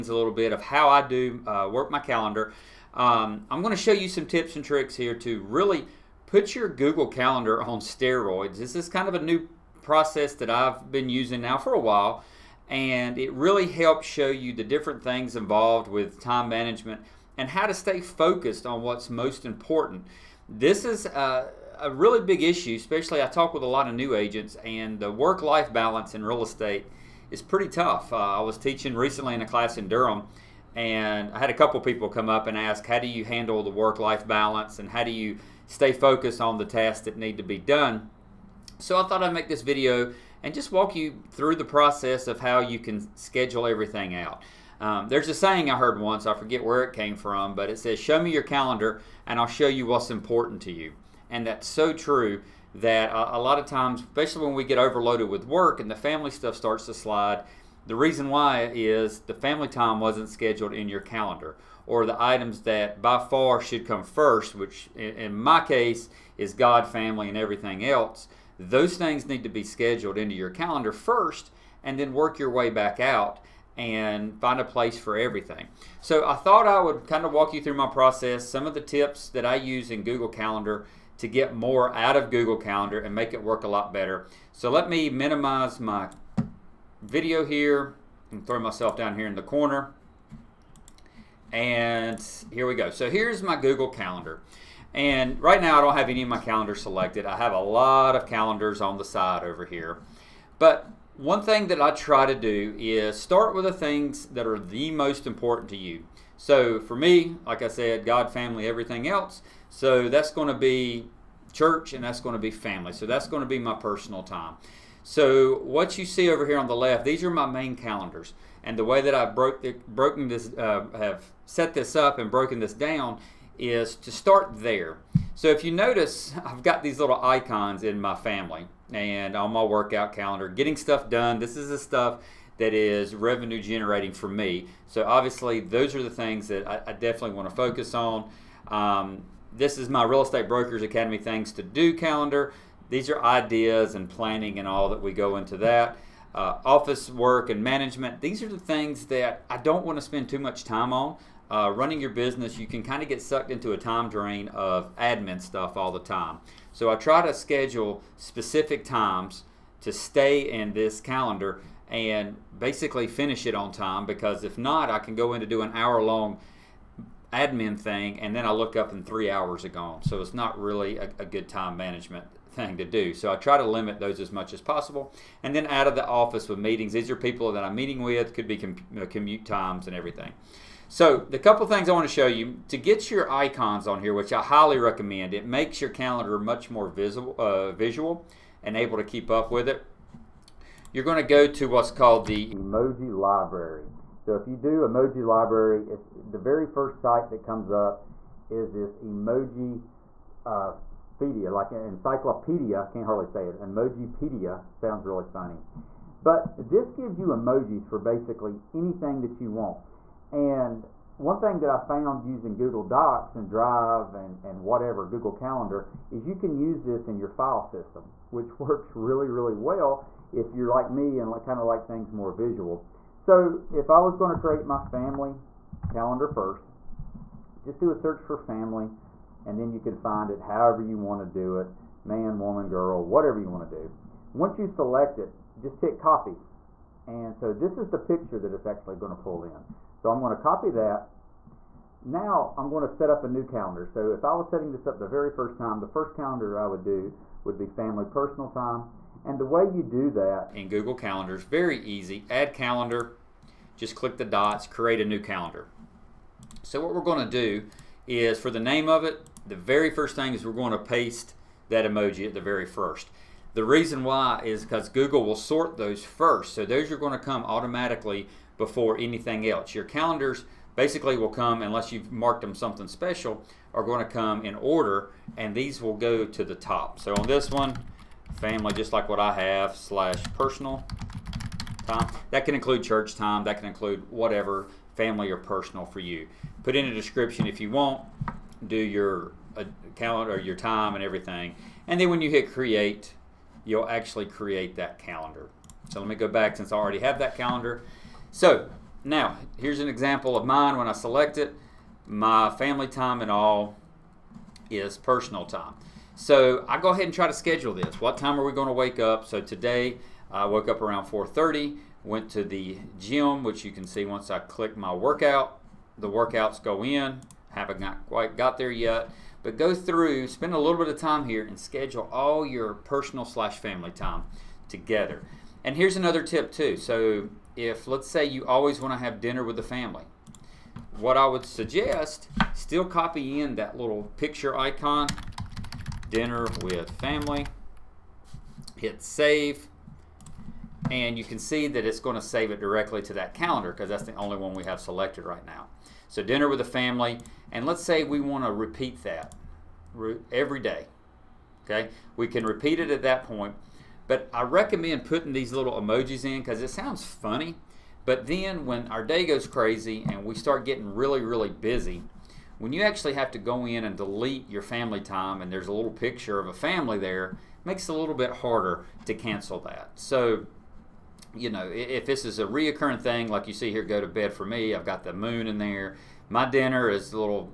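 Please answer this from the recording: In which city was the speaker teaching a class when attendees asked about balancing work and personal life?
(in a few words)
Durham.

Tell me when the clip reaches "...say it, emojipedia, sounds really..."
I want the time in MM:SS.
03:23.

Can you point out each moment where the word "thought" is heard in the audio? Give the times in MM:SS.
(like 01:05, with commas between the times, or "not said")
00:39, 01:16.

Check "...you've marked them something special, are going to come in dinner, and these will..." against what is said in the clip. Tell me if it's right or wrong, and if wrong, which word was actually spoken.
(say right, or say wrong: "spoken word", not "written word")
wrong: "order", not "dinner".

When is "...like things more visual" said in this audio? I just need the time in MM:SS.
03:41.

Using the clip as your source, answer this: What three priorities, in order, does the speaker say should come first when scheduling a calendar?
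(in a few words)
God, family, everything else.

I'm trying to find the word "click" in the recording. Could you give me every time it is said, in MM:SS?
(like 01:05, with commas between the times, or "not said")
04:13, 05:14.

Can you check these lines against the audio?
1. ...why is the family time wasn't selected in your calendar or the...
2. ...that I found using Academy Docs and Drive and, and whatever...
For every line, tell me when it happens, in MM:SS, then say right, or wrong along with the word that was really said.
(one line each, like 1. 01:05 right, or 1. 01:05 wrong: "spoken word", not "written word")
1. 00:58 wrong: "scheduled", not "selected"
2. 03:31 wrong: "Google", not "Academy".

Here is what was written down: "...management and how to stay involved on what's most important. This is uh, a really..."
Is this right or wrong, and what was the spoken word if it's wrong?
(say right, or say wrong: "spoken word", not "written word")
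wrong: "focused", not "involved".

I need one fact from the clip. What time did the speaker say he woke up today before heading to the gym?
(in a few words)
4:30.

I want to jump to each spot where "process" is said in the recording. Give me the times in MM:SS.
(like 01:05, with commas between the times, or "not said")
00:09, 00:41, 01:17.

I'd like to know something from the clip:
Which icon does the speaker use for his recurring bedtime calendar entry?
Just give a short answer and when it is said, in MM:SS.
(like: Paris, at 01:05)
the moon, at 06:15.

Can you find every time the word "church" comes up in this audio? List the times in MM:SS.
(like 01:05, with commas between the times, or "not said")
01:51, 04:42.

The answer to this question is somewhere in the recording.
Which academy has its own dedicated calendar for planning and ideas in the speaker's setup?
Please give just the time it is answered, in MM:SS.
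02:20.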